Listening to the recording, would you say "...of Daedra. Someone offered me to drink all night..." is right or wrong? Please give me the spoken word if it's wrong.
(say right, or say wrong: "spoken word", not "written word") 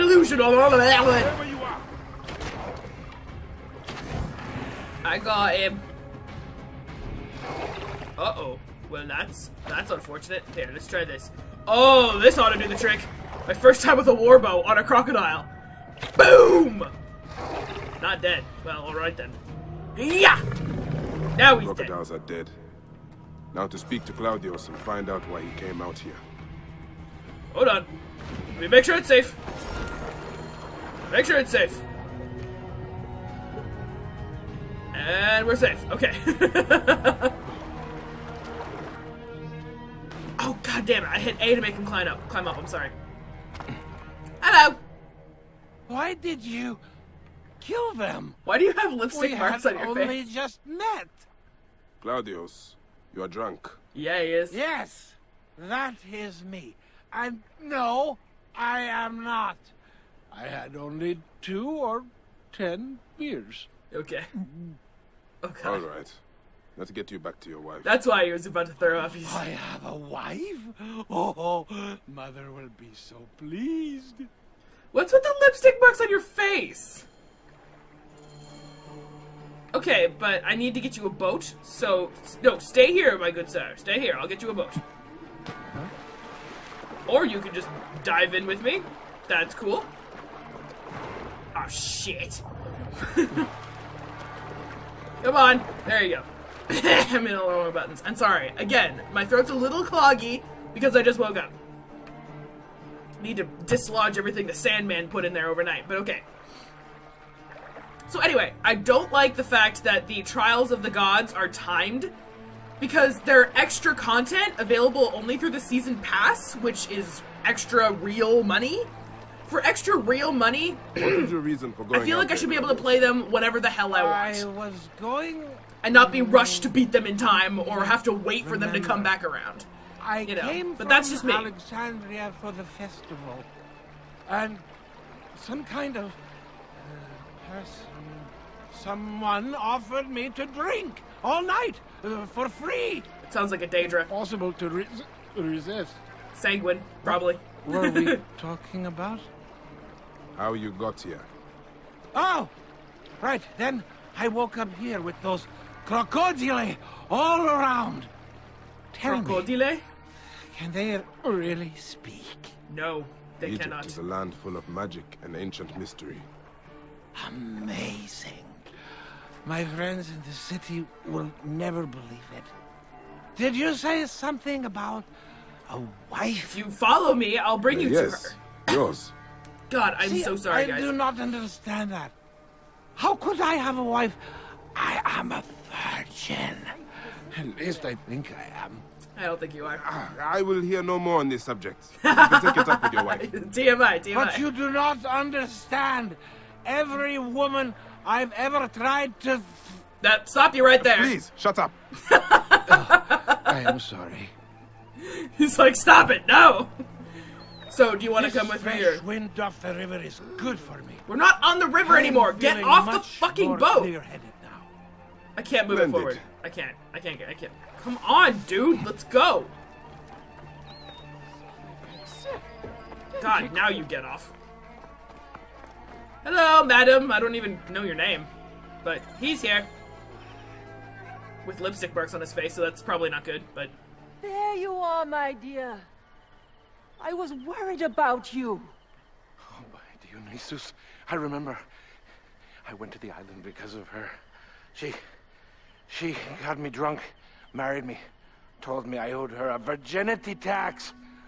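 wrong: "Yes", not "Daedra".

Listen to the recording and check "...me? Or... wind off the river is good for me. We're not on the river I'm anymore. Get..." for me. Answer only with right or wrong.
right.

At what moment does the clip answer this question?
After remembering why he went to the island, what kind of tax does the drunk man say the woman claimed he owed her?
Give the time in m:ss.
4:09.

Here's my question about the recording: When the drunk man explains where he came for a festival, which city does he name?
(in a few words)
Alexandria.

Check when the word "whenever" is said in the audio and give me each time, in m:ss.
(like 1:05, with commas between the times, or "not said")
2:03.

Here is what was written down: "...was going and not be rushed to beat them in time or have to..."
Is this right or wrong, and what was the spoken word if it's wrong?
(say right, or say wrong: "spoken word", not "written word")
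right.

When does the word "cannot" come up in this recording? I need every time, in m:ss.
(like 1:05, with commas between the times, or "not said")
2:43.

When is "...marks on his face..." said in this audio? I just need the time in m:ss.
3:51.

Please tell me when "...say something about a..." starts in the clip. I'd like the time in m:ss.
2:53.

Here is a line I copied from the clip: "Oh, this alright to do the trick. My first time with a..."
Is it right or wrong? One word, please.
wrong.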